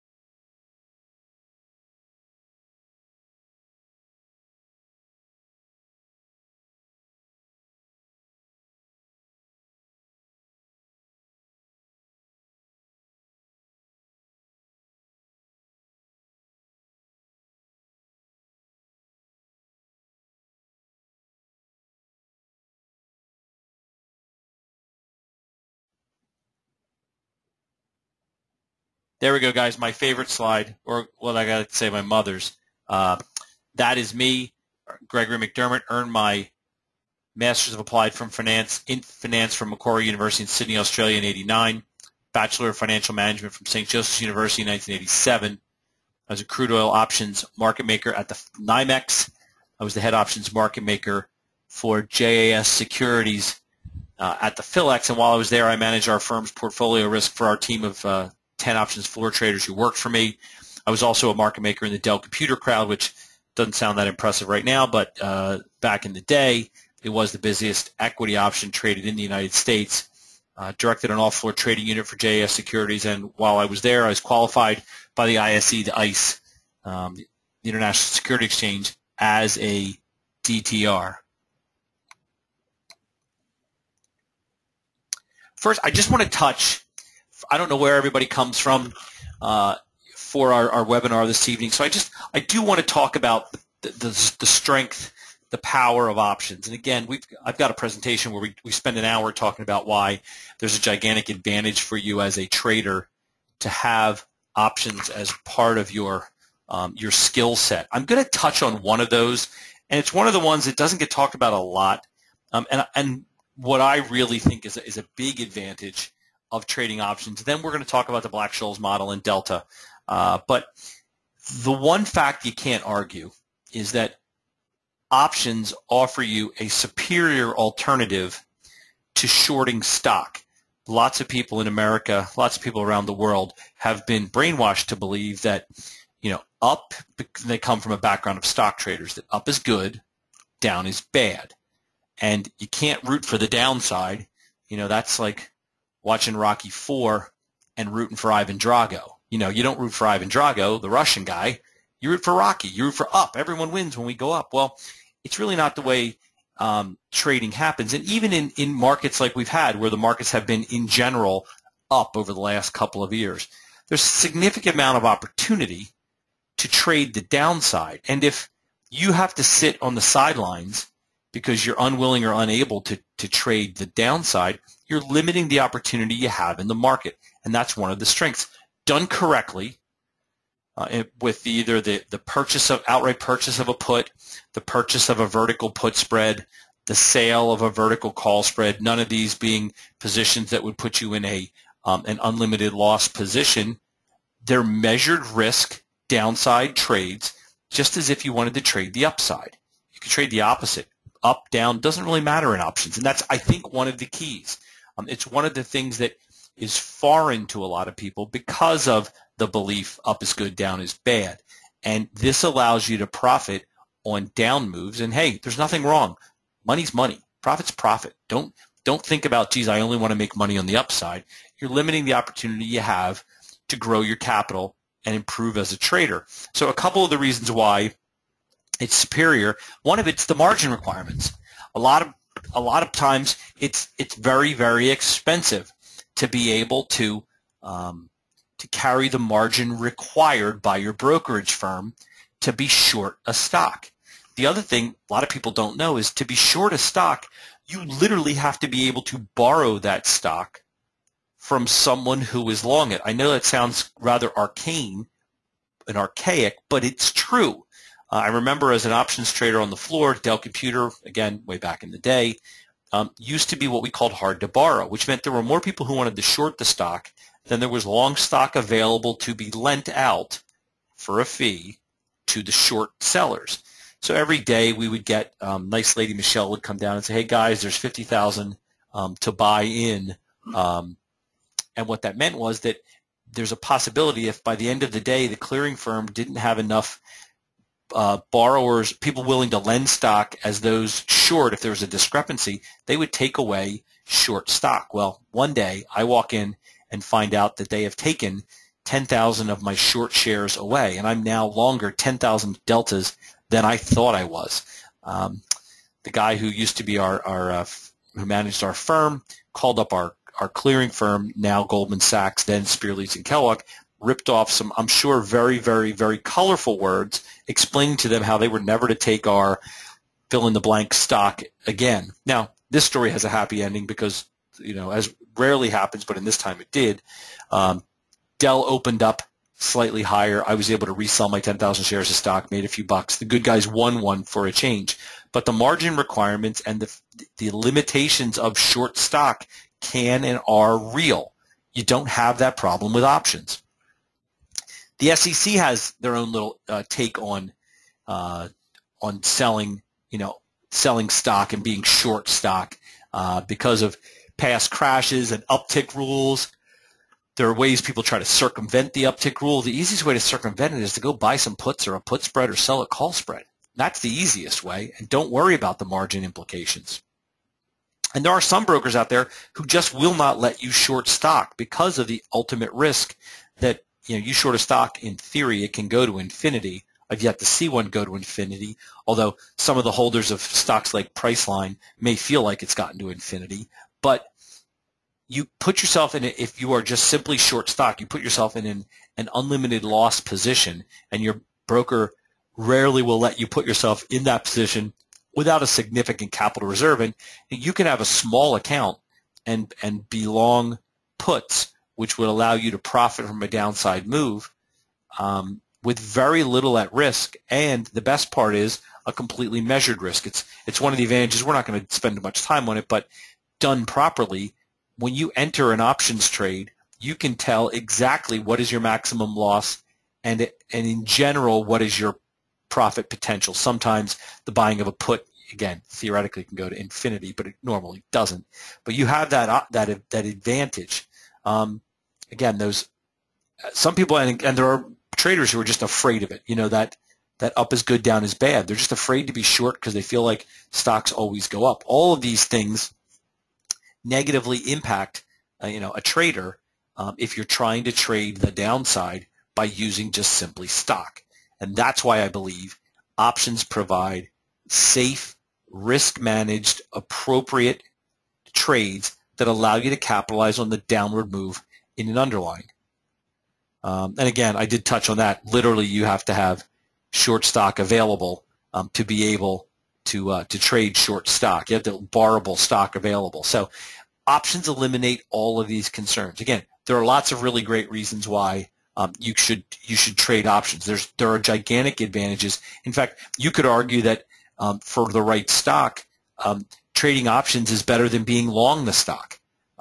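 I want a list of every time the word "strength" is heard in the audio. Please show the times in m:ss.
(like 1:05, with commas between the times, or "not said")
1:34, 2:58.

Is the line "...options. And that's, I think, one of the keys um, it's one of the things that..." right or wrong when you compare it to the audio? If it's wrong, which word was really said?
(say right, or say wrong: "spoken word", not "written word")
right.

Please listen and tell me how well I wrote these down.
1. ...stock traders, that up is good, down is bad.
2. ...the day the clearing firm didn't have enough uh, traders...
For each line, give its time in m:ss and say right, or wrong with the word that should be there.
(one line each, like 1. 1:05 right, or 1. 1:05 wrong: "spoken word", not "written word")
1. 2:18 right
2. 4:44 wrong: "borrowers", not "traders".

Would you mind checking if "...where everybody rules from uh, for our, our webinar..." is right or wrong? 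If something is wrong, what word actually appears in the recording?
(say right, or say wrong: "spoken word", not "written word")
wrong: "comes", not "rules".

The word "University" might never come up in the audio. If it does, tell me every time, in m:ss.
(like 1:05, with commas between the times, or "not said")
0:40, 0:44.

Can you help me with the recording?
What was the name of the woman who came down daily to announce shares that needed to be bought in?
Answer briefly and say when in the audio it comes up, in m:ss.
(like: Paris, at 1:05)
Michelle, at 4:36.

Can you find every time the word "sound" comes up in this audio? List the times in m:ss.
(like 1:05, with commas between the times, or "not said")
1:03, 4:13.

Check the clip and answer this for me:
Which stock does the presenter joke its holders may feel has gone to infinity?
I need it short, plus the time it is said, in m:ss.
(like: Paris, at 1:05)
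Priceline, at 6:21.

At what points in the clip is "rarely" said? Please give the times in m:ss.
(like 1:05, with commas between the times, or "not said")
5:25, 6:32.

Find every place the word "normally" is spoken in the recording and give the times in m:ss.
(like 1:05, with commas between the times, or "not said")
7:07.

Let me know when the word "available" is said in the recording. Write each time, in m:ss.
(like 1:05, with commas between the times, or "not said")
4:28, 7:47, 7:52.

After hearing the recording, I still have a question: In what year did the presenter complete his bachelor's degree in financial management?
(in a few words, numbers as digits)
1987.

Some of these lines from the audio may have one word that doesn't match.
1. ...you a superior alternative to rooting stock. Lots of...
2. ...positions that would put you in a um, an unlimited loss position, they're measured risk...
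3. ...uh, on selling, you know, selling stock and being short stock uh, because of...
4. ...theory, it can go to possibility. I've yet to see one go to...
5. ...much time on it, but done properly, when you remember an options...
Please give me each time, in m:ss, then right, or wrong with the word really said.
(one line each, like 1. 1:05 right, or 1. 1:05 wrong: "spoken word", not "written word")
1. 2:06 wrong: "shorting", not "rooting"
2. 3:09 right
3. 5:48 right
4. 6:15 wrong: "infinity", not "possibility"
5. 6:52 wrong: "enter", not "remember".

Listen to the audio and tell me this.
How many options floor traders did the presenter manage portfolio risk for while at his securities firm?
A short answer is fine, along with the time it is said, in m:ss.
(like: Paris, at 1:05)
10, at 0:58.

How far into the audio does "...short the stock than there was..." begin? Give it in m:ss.
4:26.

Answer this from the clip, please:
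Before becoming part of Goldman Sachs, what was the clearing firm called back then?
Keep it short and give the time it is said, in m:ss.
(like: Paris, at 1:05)
Spear, Leeds and Kellogg, at 5:12.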